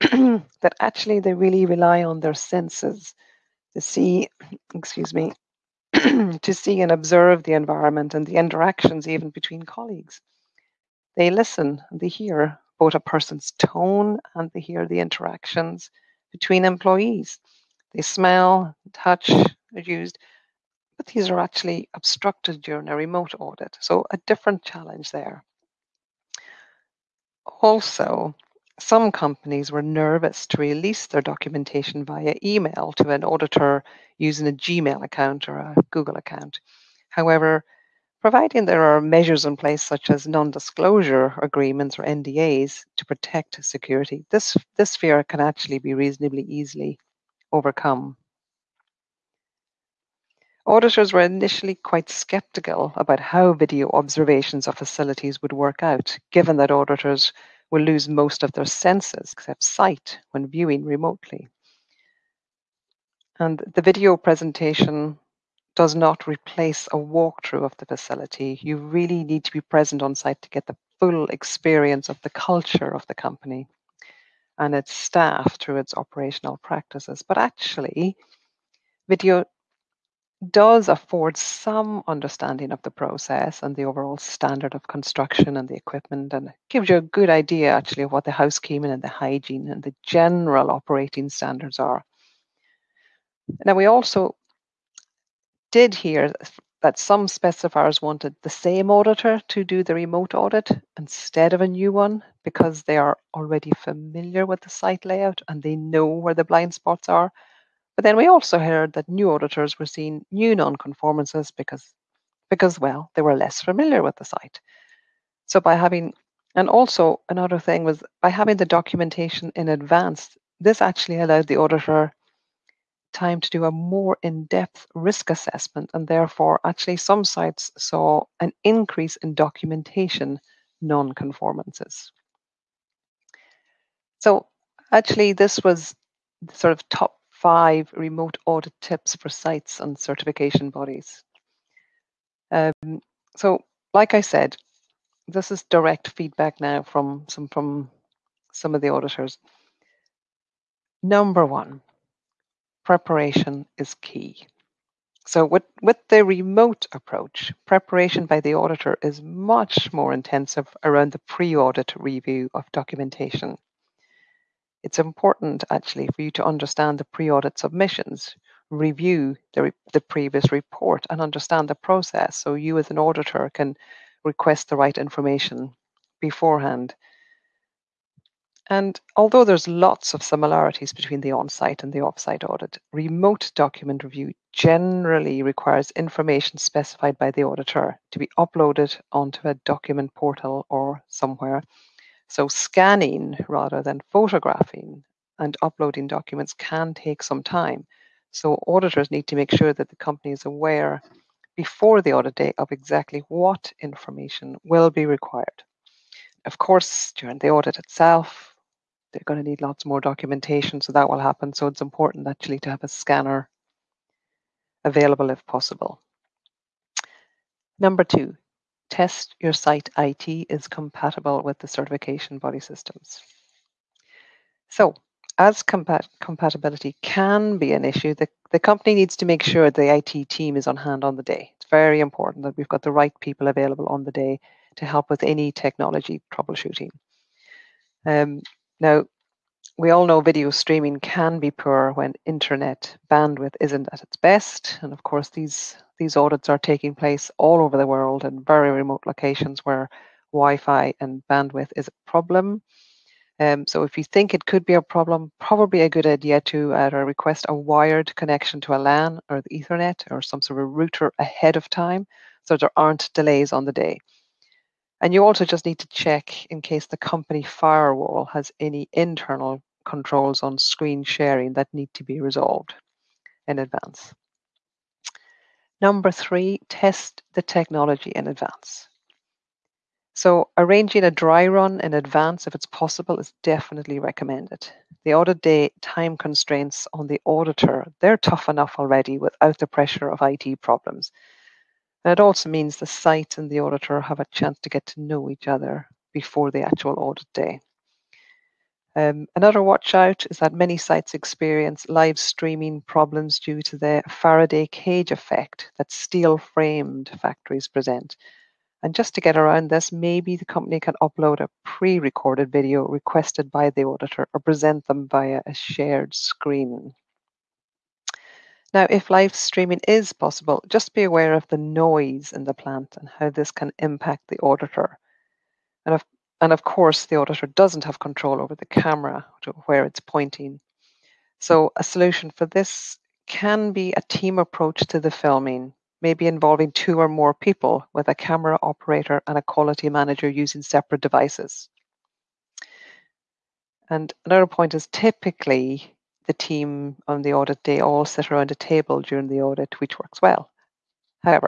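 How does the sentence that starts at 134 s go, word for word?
So, actually, this was sort of top five remote audit tips for sites and certification bodies.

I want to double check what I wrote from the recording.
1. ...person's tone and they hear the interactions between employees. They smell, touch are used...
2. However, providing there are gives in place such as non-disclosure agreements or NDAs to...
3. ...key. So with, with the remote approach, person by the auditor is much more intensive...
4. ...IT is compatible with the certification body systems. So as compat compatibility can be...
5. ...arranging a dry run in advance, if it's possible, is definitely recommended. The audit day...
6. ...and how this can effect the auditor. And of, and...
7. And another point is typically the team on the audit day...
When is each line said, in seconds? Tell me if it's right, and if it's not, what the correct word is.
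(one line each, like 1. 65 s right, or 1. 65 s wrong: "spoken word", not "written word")
1. 13 s right
2. 37 s wrong: "measures", not "gives"
3. 153 s wrong: "preparation", not "person"
4. 219 s right
5. 280 s right
6. 322 s wrong: "impact", not "effect"
7. 343 s right.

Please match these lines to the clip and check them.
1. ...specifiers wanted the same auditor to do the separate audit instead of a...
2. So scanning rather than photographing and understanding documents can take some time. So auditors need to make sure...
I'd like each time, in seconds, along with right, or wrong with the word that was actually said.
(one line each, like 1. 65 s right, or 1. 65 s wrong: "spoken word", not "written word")
1. 97 s wrong: "remote", not "separate"
2. 192 s wrong: "uploading", not "understanding".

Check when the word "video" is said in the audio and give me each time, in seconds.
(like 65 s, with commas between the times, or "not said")
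53 s, 63 s, 79 s, 240 s, 312 s.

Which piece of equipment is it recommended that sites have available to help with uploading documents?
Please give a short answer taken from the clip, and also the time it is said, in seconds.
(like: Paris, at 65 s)
a scanner, at 212 s.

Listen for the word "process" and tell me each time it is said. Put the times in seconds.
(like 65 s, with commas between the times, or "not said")
82 s, 171 s.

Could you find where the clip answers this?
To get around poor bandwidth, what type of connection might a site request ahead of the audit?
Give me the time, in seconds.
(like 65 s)
257 s.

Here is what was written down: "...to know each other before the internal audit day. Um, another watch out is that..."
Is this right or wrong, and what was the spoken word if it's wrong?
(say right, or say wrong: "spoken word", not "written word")
wrong: "actual", not "internal".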